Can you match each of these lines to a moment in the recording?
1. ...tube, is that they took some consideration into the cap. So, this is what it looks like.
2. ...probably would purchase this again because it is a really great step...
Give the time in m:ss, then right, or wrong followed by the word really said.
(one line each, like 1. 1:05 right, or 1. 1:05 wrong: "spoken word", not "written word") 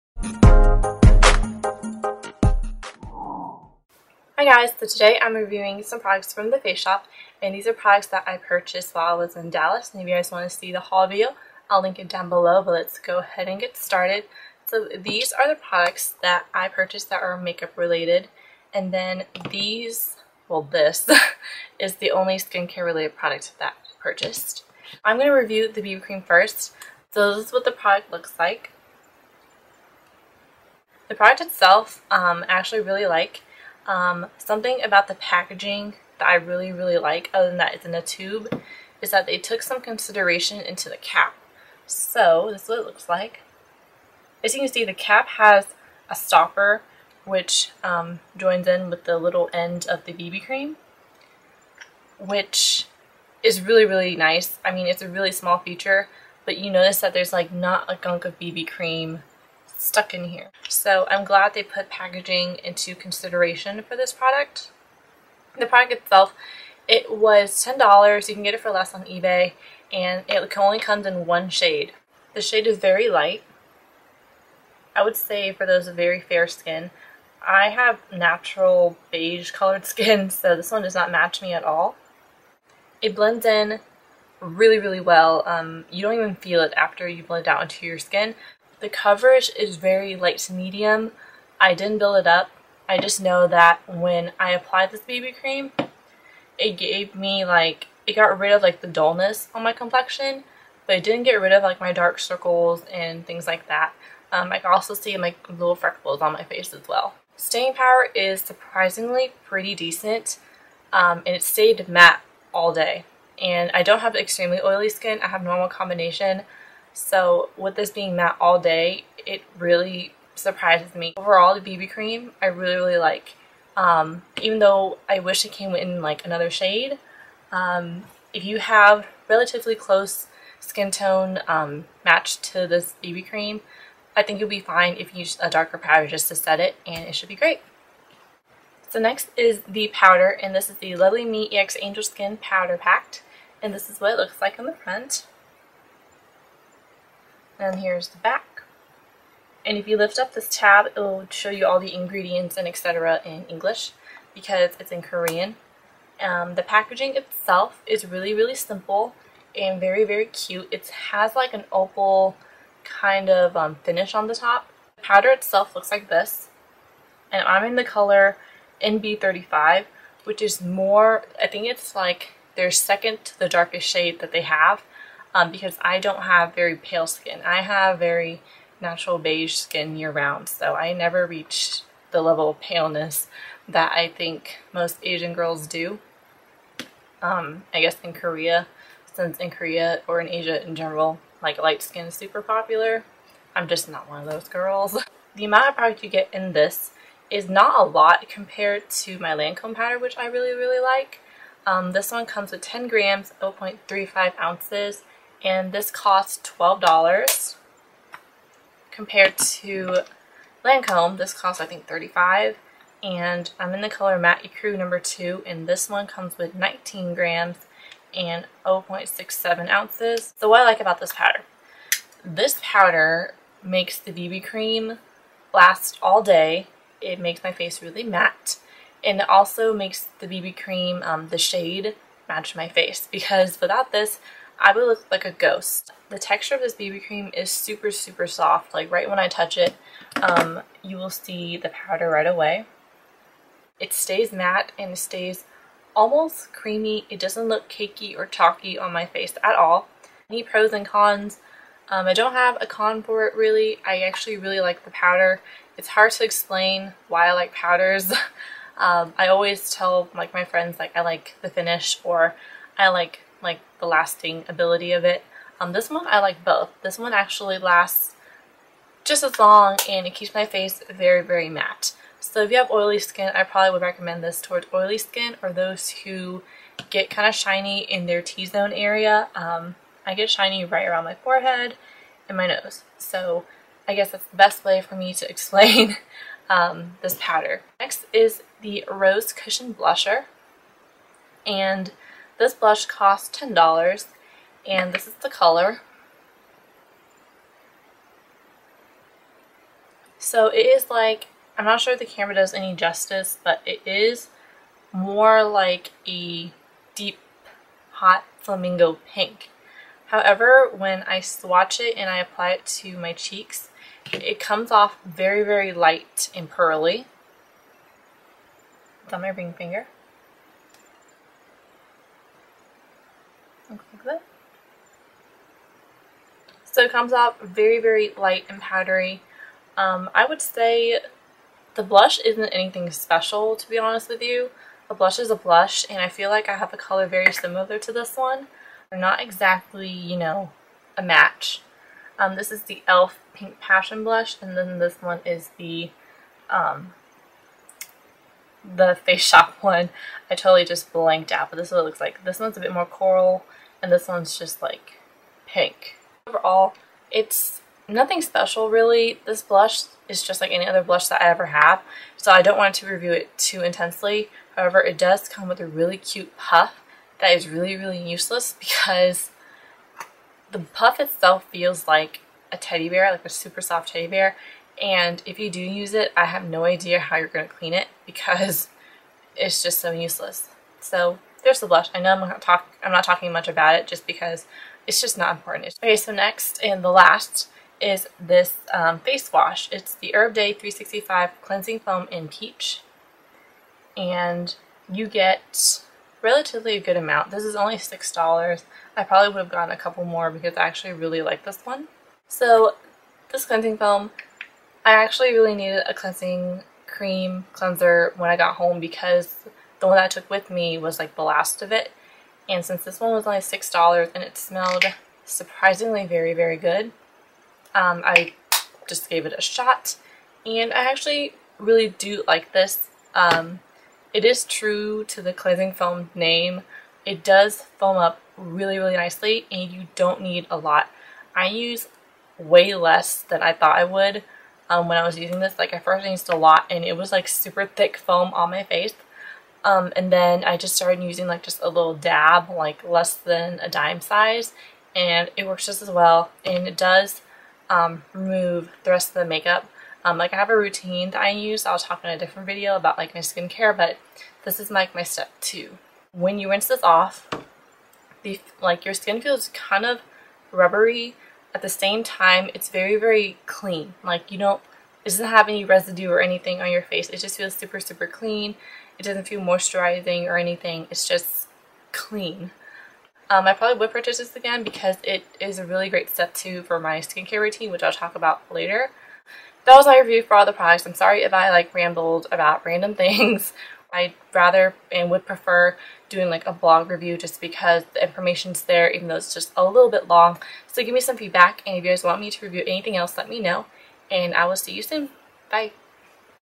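1. 0:38 right
2. 7:53 right.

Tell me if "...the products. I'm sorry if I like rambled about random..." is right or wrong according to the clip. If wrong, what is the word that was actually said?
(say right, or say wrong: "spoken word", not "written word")
right.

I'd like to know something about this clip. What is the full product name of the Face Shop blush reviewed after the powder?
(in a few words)
Rose Cushion Blusher.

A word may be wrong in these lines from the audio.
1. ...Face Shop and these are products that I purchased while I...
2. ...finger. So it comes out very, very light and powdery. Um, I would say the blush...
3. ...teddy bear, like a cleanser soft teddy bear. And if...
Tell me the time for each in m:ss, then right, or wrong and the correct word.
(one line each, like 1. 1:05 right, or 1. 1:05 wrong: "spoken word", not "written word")
1. 0:06 right
2. 5:19 right
3. 6:12 wrong: "super", not "cleanser".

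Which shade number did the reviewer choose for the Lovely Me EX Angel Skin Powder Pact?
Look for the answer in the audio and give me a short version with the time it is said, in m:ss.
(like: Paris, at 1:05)
NB35, at 2:48.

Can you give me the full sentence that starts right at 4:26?
This one actually lasts just as long and it keeps my face very, very matte.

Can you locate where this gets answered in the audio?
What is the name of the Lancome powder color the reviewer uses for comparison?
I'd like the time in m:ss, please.
3:34.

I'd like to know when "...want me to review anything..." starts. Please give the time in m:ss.
8:12.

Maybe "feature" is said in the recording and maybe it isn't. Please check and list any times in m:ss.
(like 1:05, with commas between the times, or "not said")
0:55.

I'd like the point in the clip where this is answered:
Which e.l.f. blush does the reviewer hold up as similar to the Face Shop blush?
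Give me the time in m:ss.
5:43.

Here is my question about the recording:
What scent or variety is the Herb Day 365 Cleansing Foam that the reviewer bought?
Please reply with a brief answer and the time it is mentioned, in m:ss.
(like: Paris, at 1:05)
Peach, at 6:32.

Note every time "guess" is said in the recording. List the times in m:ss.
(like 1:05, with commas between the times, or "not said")
3:07, 4:43.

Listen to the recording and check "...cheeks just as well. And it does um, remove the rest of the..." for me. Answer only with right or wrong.
wrong.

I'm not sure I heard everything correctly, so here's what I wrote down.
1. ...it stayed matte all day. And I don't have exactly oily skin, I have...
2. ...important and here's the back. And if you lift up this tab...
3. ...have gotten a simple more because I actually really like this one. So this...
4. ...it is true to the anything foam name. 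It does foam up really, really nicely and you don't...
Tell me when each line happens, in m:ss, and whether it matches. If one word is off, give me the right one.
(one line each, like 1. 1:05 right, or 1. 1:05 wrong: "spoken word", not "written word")
1. 1:51 wrong: "extremely", not "exactly"
2. 2:24 wrong: "front", not "important"
3. 6:39 wrong: "couple", not "simple"
4. 7:04 wrong: "cleansing", not "anything".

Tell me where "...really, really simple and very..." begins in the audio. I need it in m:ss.
2:38.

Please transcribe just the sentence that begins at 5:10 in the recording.
However, when I swatch it and I apply it to my cheeks, it comes off very, very light and pearly.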